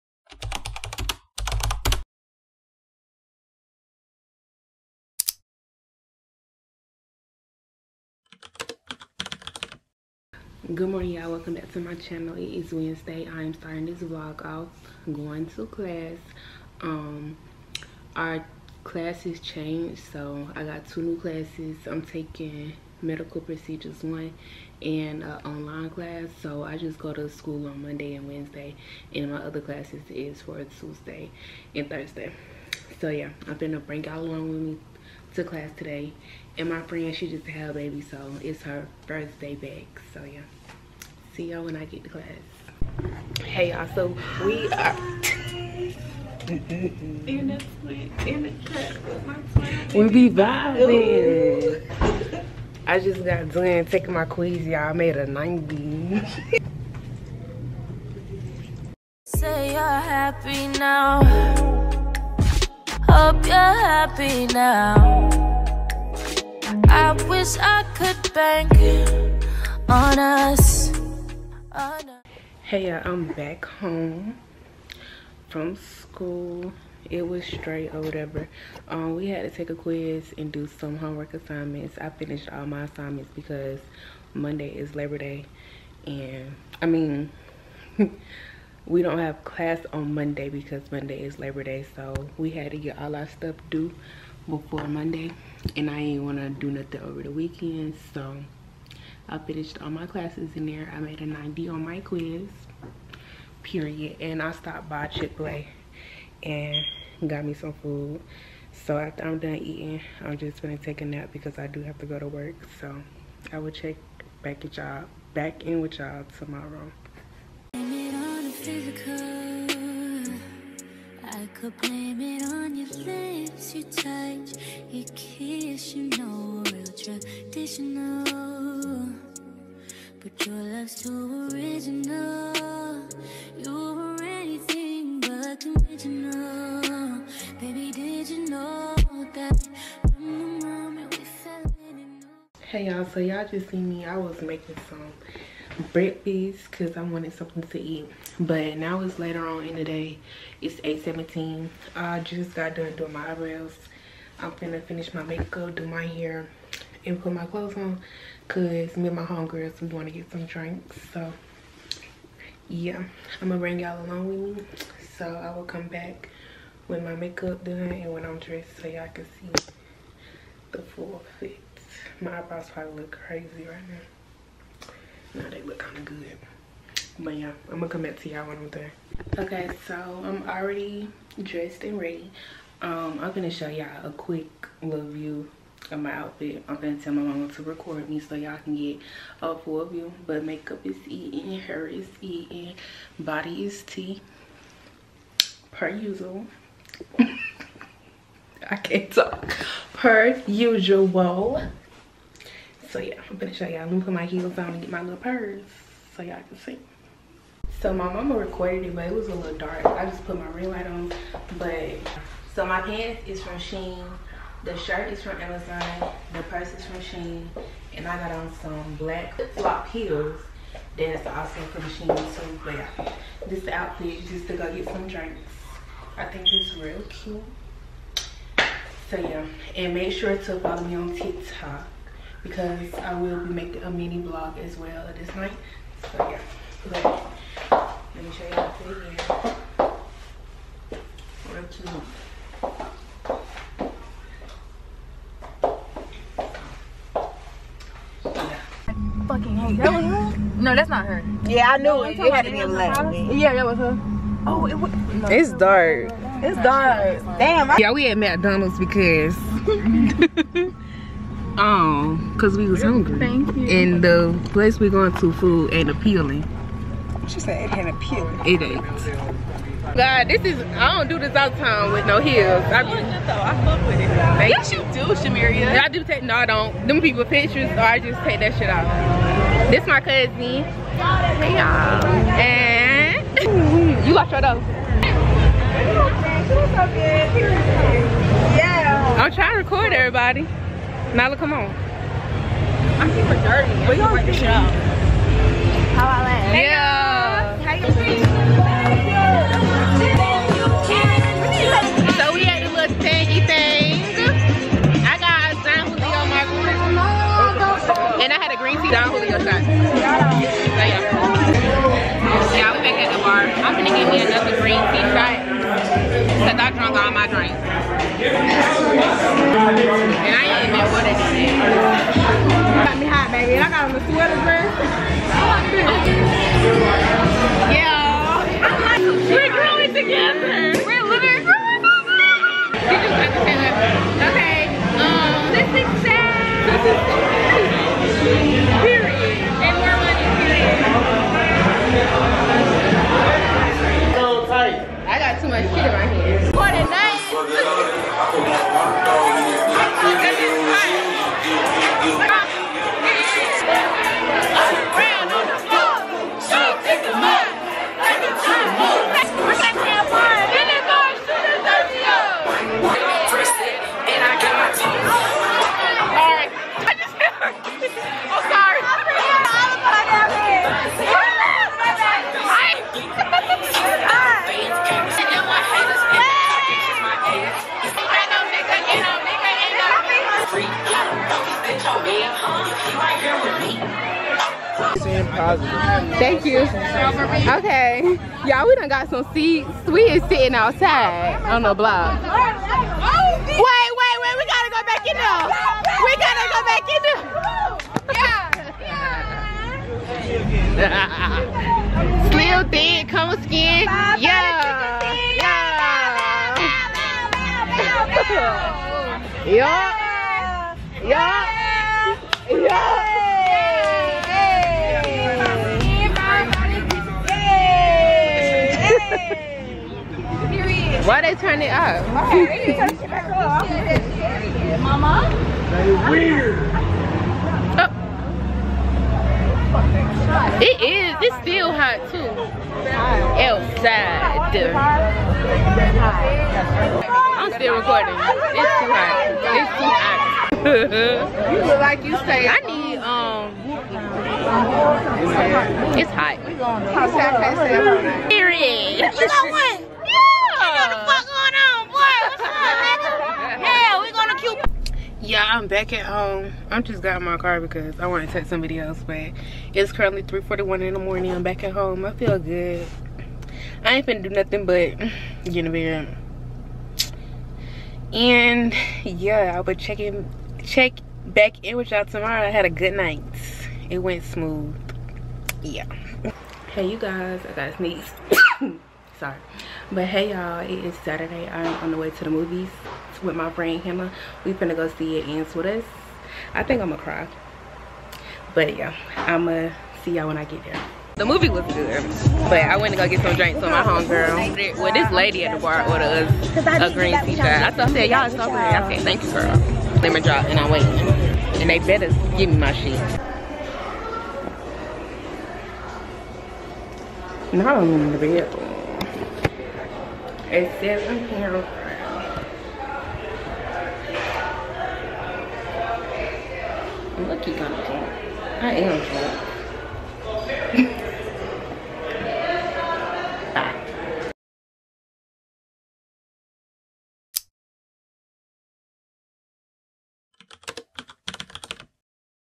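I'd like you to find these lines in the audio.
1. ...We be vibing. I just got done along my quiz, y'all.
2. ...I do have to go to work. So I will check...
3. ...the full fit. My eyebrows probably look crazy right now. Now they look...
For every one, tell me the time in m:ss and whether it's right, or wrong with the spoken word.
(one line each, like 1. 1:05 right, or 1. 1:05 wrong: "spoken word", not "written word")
1. 0:49 wrong: "taking", not "along"
2. 1:51 right
3. 2:50 right.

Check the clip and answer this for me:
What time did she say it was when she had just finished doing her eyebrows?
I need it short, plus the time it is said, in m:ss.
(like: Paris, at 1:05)
8:17, at 2:30.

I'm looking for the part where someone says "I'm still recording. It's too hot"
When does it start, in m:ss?
7:17.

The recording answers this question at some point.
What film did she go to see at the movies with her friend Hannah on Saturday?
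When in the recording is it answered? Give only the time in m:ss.
8:05.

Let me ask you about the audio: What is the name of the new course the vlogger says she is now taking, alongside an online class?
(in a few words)
Medical procedures one.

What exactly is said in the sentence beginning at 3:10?
But makeup is eating, hair is eating, body is tea, per usual.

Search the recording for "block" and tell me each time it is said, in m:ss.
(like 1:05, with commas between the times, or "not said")
6:31.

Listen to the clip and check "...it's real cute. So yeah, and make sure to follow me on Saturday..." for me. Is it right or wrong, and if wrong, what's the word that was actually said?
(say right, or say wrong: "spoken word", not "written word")
wrong: "TikTok", not "Saturday".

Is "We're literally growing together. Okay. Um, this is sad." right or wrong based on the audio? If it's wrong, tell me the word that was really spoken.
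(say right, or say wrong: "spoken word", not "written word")
right.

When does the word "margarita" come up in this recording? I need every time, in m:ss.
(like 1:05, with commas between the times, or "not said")
5:06.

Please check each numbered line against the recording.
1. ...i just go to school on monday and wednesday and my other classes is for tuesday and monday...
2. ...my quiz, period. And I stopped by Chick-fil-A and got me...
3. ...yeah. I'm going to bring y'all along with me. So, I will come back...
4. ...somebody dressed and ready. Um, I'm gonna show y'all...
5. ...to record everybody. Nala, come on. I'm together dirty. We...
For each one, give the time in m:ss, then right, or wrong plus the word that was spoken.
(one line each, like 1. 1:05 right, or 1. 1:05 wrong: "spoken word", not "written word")
1. 0:26 wrong: "thursday", not "monday"
2. 1:41 right
3. 2:42 right
4. 3:00 wrong: "already", not "somebody"
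5. 4:49 wrong: "super", not "together".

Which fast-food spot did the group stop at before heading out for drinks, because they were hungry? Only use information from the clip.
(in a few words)
McDonald's.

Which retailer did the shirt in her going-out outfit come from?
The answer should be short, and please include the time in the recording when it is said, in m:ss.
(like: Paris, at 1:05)
Amazon, at 3:35.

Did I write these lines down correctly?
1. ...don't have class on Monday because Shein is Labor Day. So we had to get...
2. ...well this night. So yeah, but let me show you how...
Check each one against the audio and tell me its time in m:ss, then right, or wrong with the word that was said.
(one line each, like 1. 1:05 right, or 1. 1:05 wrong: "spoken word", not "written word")
1. 1:29 wrong: "Monday", not "Shein"
2. 3:54 right.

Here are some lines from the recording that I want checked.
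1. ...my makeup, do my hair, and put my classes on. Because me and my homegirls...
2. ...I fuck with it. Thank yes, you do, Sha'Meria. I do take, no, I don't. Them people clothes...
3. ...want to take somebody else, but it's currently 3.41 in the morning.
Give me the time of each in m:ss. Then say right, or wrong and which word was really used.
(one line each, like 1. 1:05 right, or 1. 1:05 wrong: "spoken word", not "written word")
1. 2:35 wrong: "clothes", not "classes"
2. 4:32 wrong: "pictures", not "clothes"
3. 7:38 right.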